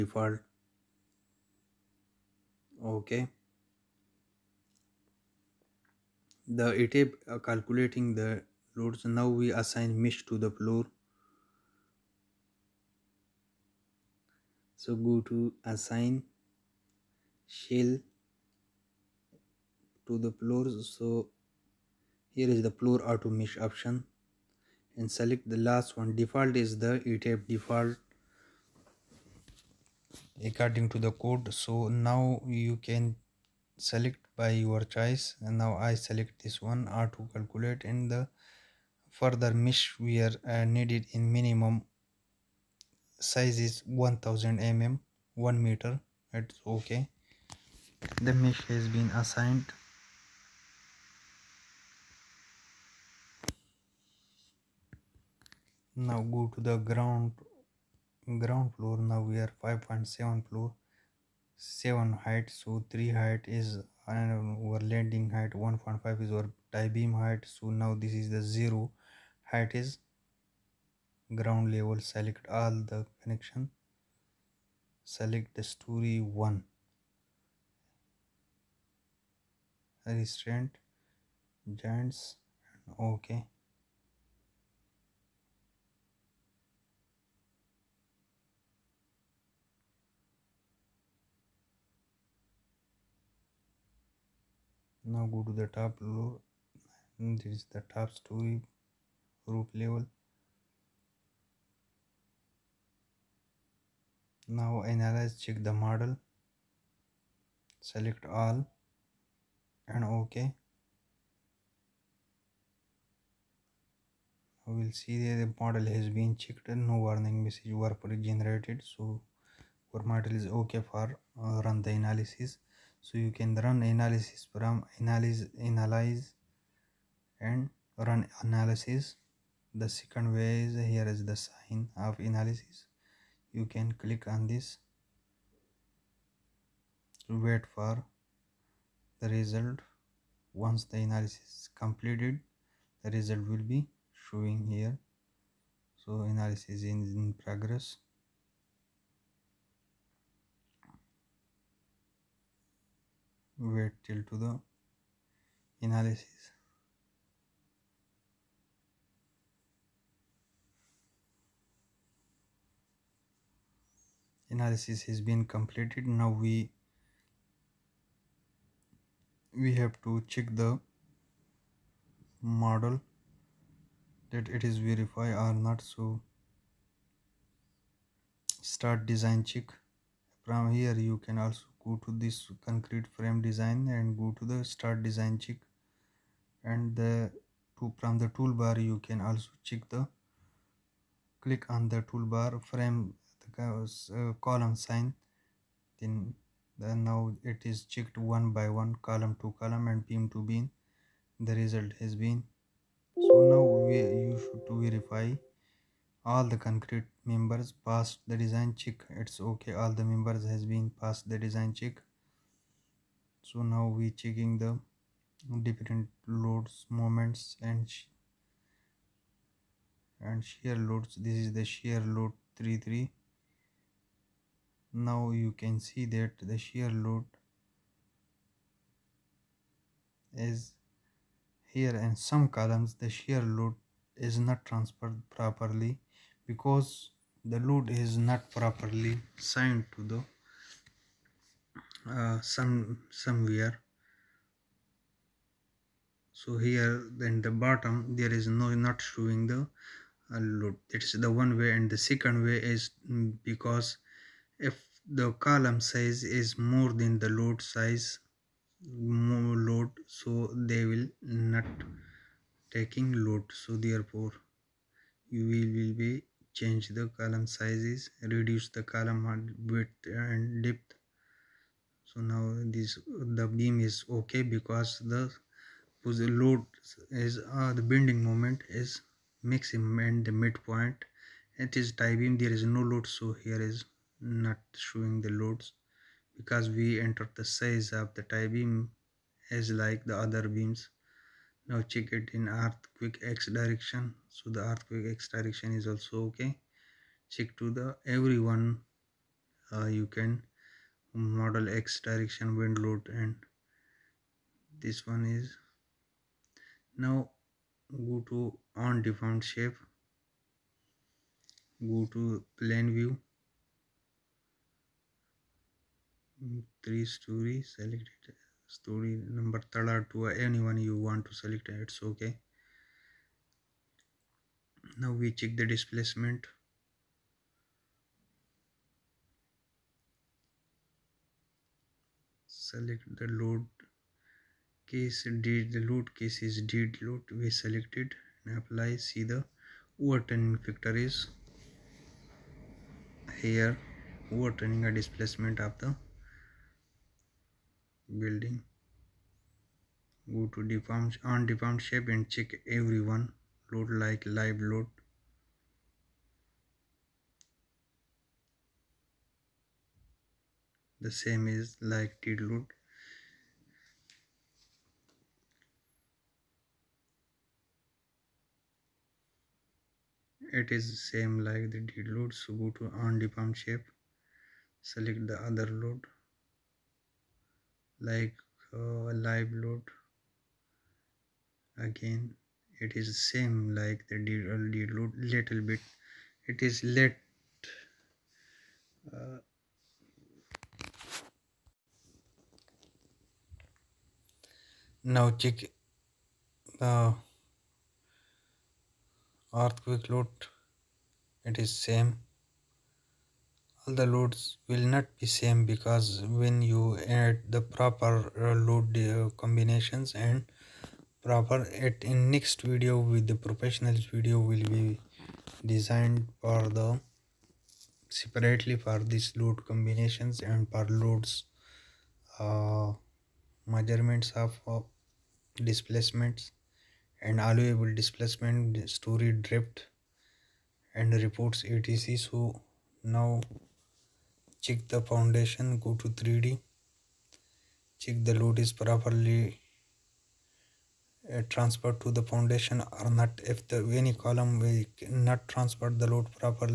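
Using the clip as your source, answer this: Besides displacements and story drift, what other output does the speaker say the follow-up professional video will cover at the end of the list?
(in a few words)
reports.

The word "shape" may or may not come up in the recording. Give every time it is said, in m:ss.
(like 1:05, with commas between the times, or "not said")
5:09, 5:51, 6:13.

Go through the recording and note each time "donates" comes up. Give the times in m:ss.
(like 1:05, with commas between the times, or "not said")
not said.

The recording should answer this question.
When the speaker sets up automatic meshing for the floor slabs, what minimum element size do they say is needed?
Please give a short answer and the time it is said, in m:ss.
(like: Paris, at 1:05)
1000 mm, at 0:43.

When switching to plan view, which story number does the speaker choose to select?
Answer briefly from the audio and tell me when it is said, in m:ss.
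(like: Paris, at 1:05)
third, at 5:19.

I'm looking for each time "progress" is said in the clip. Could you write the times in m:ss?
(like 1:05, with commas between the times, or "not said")
2:27.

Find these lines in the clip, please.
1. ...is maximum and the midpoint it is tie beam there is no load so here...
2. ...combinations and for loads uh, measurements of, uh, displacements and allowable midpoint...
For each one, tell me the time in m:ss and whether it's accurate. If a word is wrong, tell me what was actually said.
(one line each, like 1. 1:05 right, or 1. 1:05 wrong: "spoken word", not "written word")
1. 4:38 right
2. 6:59 wrong: "displacement", not "midpoint".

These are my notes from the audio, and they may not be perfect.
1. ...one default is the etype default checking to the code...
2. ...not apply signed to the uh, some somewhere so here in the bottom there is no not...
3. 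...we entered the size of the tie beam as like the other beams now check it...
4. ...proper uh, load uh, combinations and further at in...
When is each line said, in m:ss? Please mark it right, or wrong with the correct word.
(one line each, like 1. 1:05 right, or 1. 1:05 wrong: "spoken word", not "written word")
1. 0:25 wrong: "according", not "checking"
2. 3:58 wrong: "properly", not "apply"
3. 4:46 right
4. 6:47 wrong: "proper", not "further".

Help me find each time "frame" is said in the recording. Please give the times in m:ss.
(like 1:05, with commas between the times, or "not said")
3:03, 3:12.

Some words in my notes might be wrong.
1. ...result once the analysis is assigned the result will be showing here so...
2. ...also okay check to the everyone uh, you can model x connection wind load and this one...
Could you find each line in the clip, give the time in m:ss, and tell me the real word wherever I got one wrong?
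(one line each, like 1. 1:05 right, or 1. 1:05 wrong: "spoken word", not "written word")
1. 2:19 wrong: "completed", not "assigned"
2. 4:55 wrong: "direction", not "connection".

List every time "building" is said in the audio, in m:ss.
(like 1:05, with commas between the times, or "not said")
5:48.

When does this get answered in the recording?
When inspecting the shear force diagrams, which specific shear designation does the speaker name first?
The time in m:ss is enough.
3:41.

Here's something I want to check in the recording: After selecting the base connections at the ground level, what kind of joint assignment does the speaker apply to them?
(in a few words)
restraint joints.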